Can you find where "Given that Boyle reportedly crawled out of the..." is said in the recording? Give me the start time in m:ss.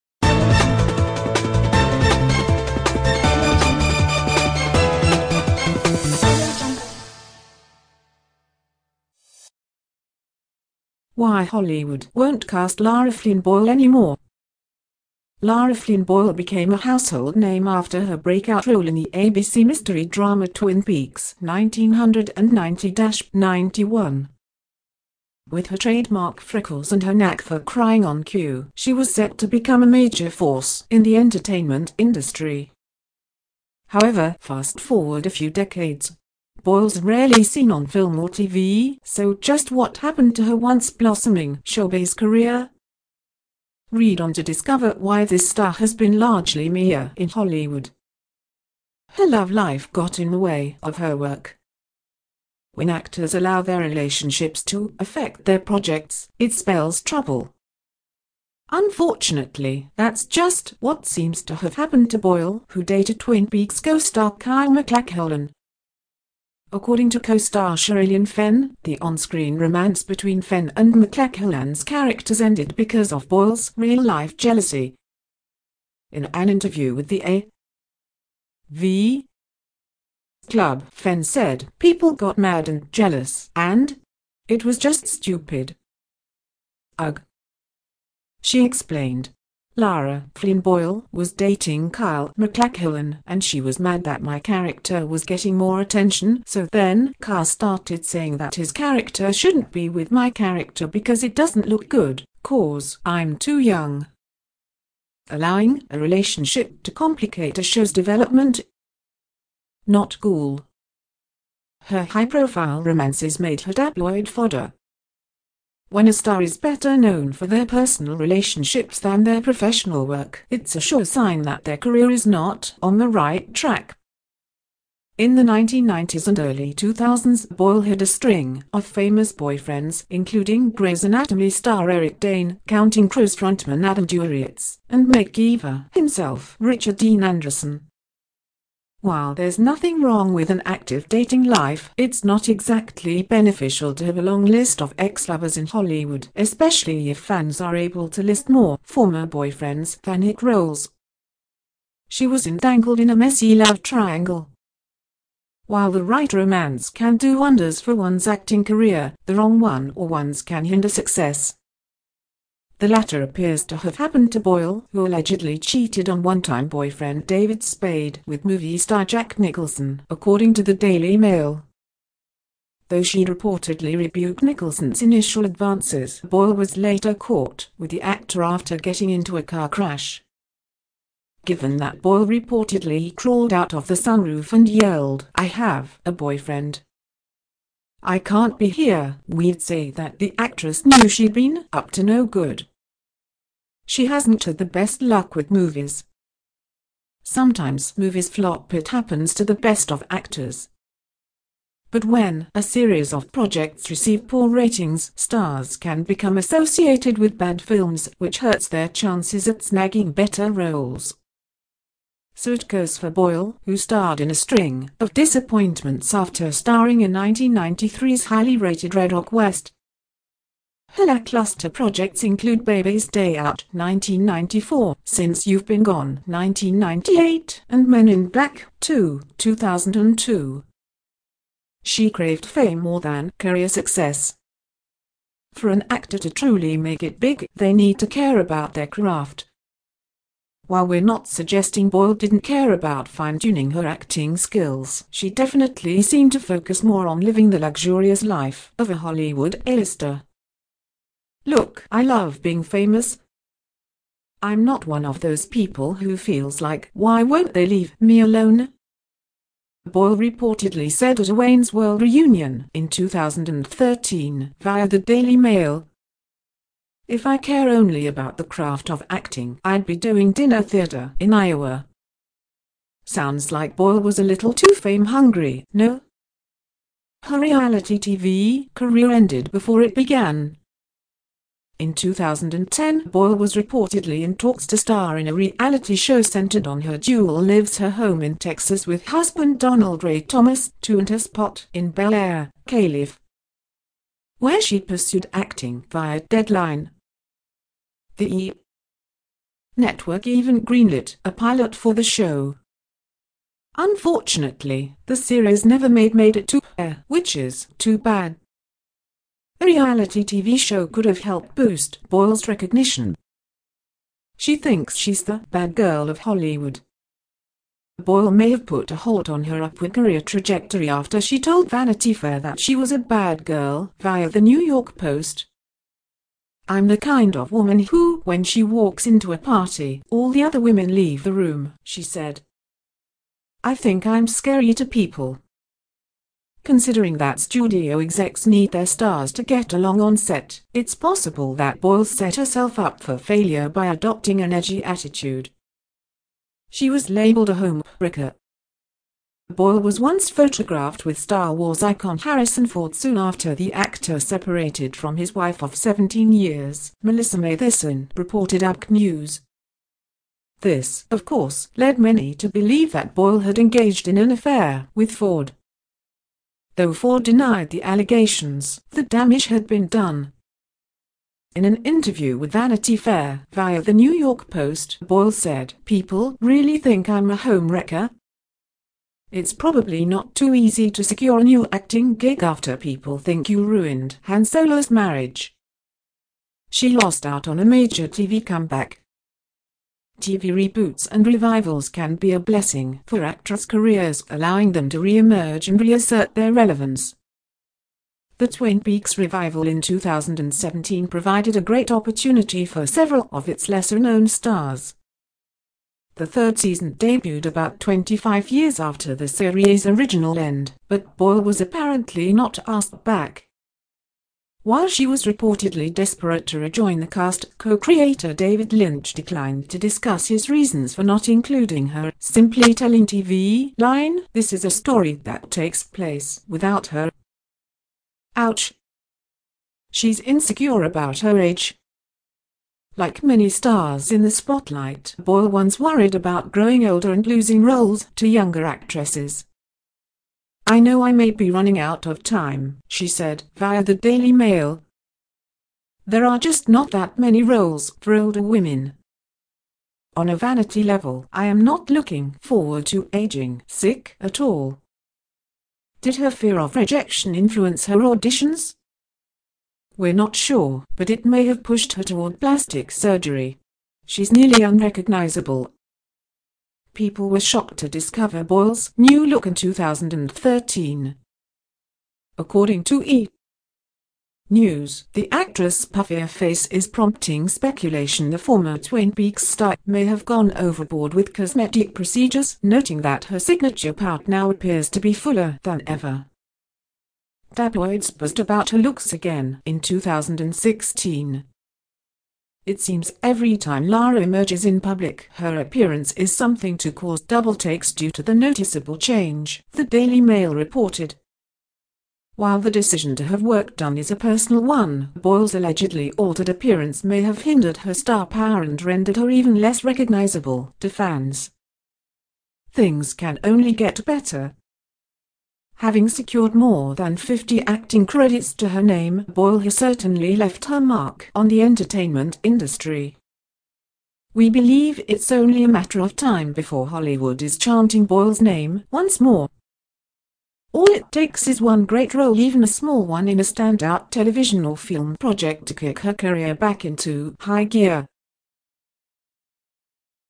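3:01.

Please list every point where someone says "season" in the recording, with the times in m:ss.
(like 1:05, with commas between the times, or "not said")
6:46.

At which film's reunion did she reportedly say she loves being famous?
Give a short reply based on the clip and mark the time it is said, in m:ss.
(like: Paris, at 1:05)
Wayne's World, at 4:21.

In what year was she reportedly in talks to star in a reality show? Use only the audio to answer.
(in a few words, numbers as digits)
2010.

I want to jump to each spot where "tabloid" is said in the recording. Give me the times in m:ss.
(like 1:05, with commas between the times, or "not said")
1:53, 8:07.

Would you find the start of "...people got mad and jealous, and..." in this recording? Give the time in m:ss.
1:21.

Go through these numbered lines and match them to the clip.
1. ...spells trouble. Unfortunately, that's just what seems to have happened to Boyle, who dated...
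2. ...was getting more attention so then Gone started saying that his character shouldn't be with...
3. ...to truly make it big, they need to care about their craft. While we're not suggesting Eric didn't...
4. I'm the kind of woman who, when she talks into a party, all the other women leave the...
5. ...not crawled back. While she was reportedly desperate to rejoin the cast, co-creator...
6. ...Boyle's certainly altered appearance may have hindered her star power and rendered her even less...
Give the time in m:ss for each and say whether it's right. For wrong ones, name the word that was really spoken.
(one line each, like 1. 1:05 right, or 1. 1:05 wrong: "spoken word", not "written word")
1. 0:56 right
2. 1:35 wrong: "Kyle", not "Gone"
3. 3:56 wrong: "Boyle", not "Eric"
4. 5:26 wrong: "walks", not "talks"
5. 6:52 wrong: "asked", not "crawled"
6. 8:25 wrong: "allegedly", not "certainly".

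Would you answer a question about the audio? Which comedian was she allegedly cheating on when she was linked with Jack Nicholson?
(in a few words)
David Spade.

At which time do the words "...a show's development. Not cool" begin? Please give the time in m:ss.
1:47.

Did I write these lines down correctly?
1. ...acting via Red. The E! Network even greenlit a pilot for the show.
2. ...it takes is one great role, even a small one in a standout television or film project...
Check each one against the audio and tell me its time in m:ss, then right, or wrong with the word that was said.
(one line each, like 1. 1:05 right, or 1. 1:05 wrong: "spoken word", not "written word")
1. 4:55 wrong: "Deadline", not "Red"
2. 8:50 right.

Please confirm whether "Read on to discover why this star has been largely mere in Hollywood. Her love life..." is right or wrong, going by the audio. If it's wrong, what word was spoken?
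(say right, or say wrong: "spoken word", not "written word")
right.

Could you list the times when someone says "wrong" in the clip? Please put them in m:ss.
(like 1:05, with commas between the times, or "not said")
2:20, 2:39.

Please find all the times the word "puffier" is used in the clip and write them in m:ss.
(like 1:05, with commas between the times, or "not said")
7:55.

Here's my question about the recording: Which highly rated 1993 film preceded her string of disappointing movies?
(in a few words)
Red Rock West.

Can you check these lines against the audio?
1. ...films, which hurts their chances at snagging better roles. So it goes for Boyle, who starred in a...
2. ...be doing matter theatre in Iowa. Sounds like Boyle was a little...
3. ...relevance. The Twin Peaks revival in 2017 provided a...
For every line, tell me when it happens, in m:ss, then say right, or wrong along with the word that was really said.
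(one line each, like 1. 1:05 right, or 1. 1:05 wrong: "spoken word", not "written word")
1. 3:27 right
2. 4:29 wrong: "dinner", not "matter"
3. 6:36 right.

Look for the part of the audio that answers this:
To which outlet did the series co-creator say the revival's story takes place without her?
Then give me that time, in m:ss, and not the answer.
7:03.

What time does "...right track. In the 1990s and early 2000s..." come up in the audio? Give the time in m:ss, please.
2:03.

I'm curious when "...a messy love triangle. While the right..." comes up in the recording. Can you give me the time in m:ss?
2:33.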